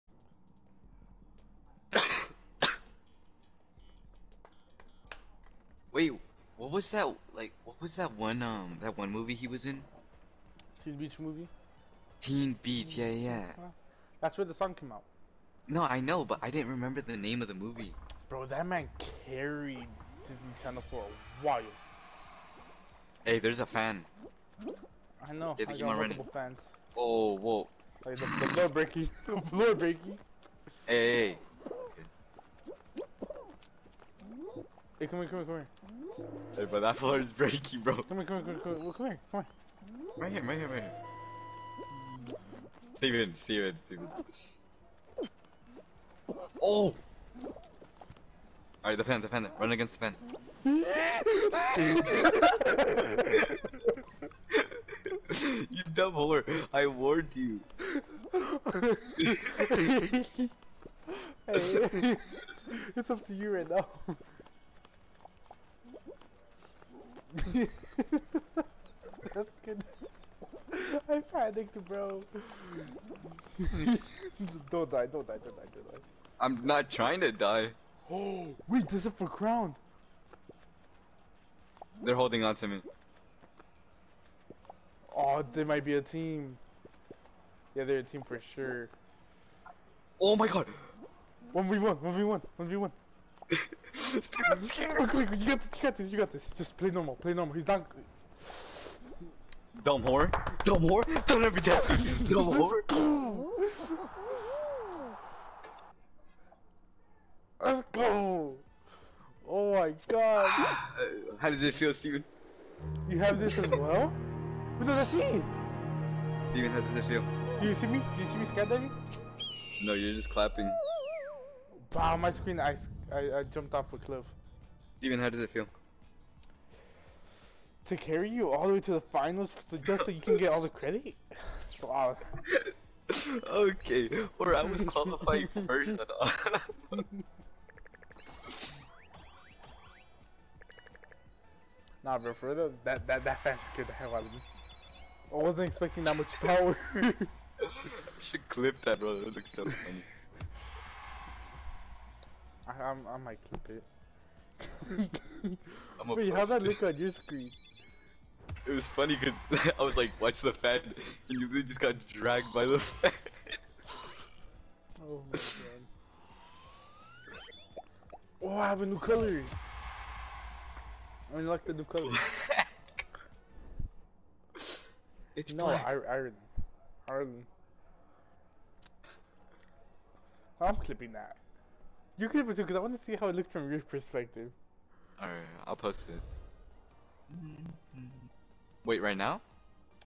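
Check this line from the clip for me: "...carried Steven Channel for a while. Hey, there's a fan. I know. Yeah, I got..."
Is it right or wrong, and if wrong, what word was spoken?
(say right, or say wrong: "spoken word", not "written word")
wrong: "Disney", not "Steven".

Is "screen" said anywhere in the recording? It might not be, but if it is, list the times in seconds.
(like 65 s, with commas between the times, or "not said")
122 s, 157 s.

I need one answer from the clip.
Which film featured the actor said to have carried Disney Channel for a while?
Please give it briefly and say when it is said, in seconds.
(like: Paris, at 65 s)
Teen Beach Movie, at 10 s.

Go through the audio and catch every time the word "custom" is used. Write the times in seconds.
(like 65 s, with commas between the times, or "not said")
not said.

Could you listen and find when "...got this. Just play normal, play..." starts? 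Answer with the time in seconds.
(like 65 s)
96 s.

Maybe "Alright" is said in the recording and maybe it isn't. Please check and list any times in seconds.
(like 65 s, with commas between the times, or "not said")
48 s, 185 s.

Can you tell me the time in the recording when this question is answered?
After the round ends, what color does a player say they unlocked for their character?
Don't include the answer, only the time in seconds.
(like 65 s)
175 s.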